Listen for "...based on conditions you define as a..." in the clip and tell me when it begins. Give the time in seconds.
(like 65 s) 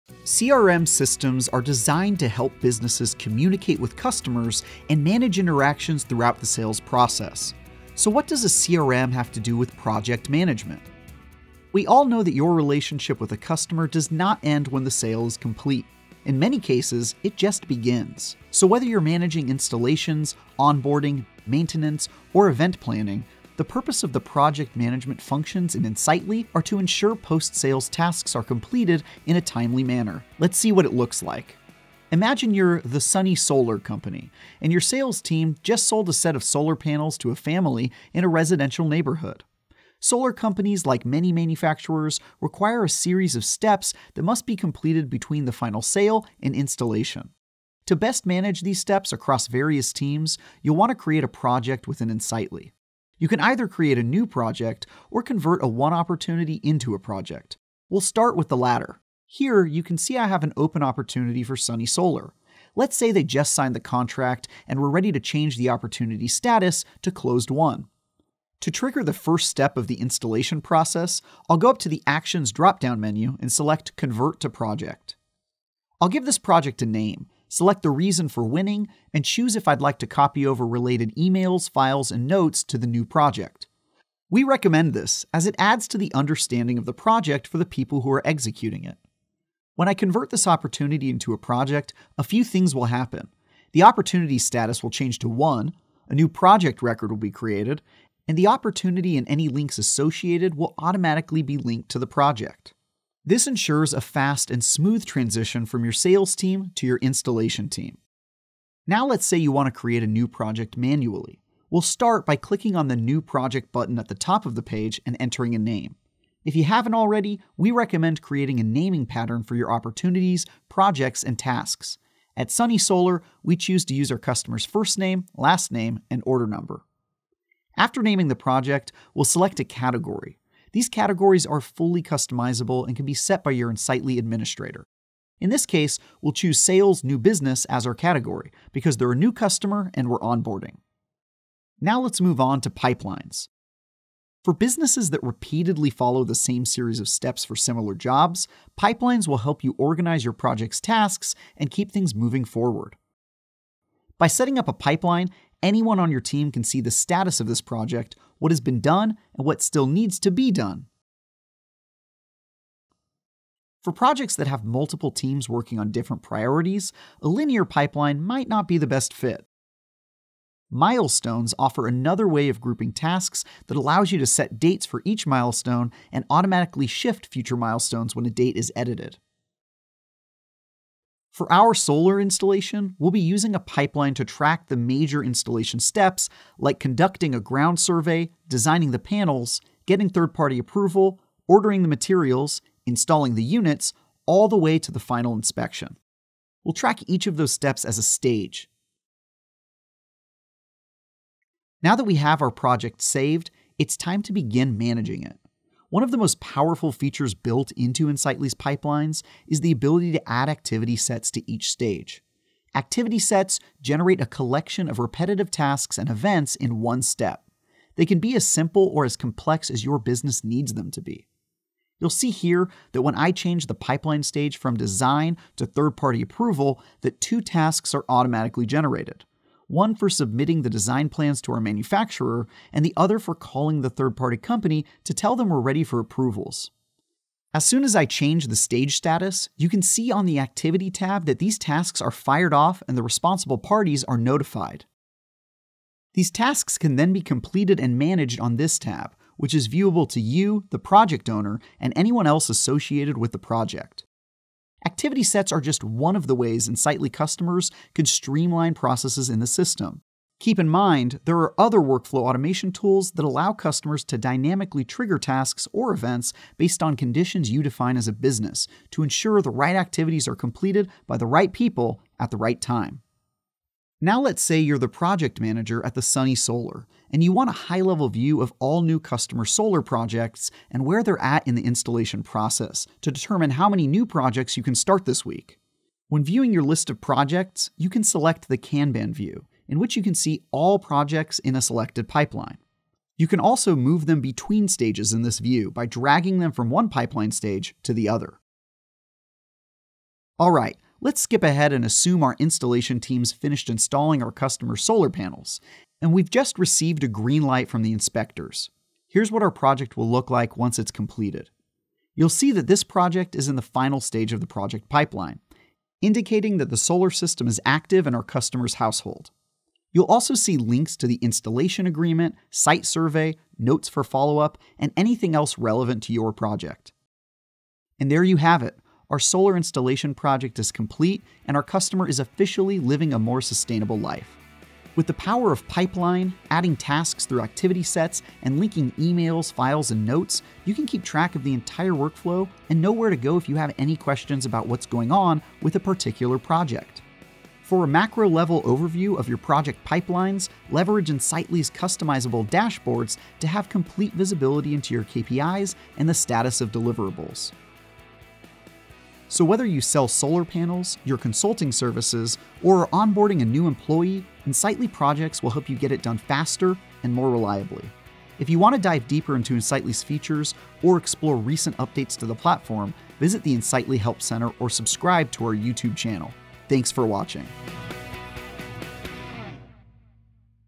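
266 s.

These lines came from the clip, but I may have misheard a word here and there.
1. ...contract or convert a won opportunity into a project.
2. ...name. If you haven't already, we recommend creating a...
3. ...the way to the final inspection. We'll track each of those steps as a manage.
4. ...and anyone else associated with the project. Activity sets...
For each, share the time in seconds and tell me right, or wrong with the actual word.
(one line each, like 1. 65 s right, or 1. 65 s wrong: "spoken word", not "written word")
1. 54 s wrong: "project", not "contract"
2. 115 s right
3. 194 s wrong: "stage", not "manage"
4. 251 s right.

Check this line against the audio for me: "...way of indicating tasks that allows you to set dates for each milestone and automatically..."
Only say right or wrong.
wrong.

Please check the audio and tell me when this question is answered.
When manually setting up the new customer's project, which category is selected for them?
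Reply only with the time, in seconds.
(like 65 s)
136 s.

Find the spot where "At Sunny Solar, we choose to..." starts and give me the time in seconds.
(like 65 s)
122 s.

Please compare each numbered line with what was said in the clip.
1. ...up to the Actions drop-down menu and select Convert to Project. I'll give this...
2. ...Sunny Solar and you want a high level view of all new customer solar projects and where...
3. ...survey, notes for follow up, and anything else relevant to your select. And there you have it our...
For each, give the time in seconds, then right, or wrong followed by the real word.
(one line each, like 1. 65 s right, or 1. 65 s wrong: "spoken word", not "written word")
1. 71 s right
2. 276 s right
3. 322 s wrong: "project", not "select".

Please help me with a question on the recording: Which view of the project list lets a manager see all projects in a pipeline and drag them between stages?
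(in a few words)
Kanban view.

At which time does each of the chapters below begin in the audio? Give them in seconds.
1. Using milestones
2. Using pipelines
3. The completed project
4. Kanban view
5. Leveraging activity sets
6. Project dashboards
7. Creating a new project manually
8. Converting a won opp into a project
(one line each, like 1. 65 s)
1. 163 s
2. 142 s
3. 300 s
4. 273 s
5. 212 s
6. 347 s
7. 108 s
8. 54 s.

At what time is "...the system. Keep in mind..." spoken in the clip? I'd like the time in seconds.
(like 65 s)
259 s.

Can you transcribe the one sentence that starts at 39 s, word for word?
Solar companies, like many manufacturers, require a series of steps that must be completed between the final sale and installation.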